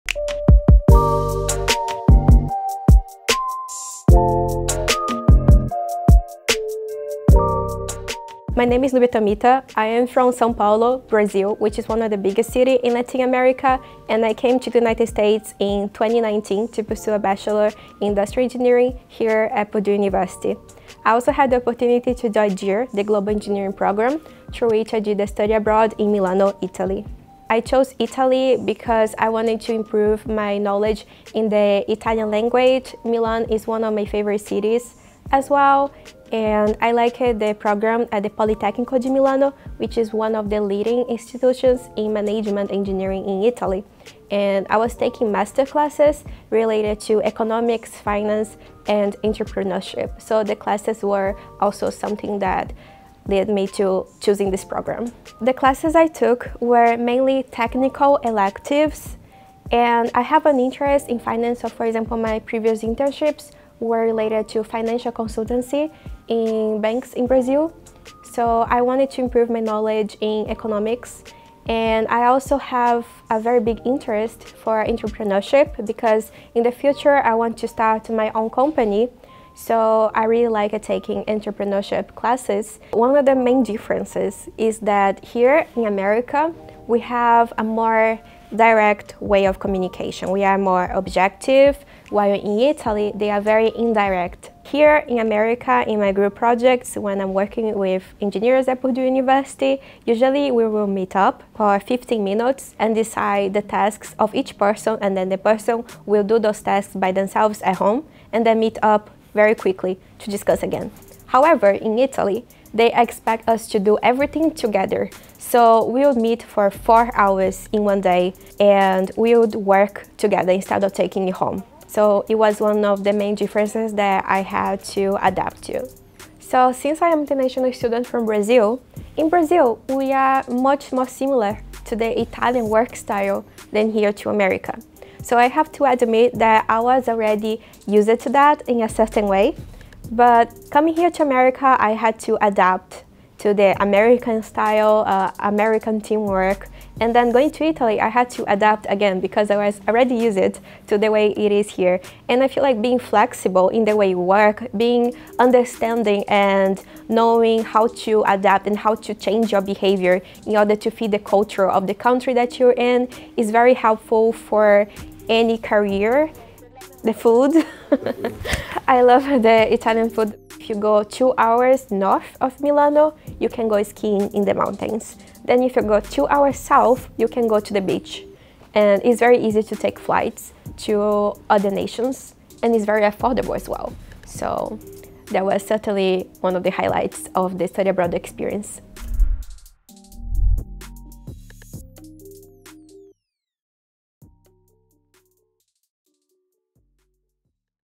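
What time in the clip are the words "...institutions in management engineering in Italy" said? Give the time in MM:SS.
00:41.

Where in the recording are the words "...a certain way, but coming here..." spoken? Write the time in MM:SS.
02:18.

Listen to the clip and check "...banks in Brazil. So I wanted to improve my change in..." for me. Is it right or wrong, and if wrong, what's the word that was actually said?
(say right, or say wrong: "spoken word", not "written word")
wrong: "knowledge", not "change".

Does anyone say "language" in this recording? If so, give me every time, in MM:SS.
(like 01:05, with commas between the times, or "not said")
00:32.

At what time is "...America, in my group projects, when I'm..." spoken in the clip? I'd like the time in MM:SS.
01:35.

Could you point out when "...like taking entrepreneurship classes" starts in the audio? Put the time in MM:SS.
01:20.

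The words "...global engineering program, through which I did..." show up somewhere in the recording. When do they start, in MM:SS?
00:23.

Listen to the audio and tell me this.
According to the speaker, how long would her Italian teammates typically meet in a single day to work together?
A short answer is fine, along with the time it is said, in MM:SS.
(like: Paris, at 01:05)
4 hours, at 01:56.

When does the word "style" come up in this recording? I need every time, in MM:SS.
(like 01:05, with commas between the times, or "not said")
02:12, 02:24.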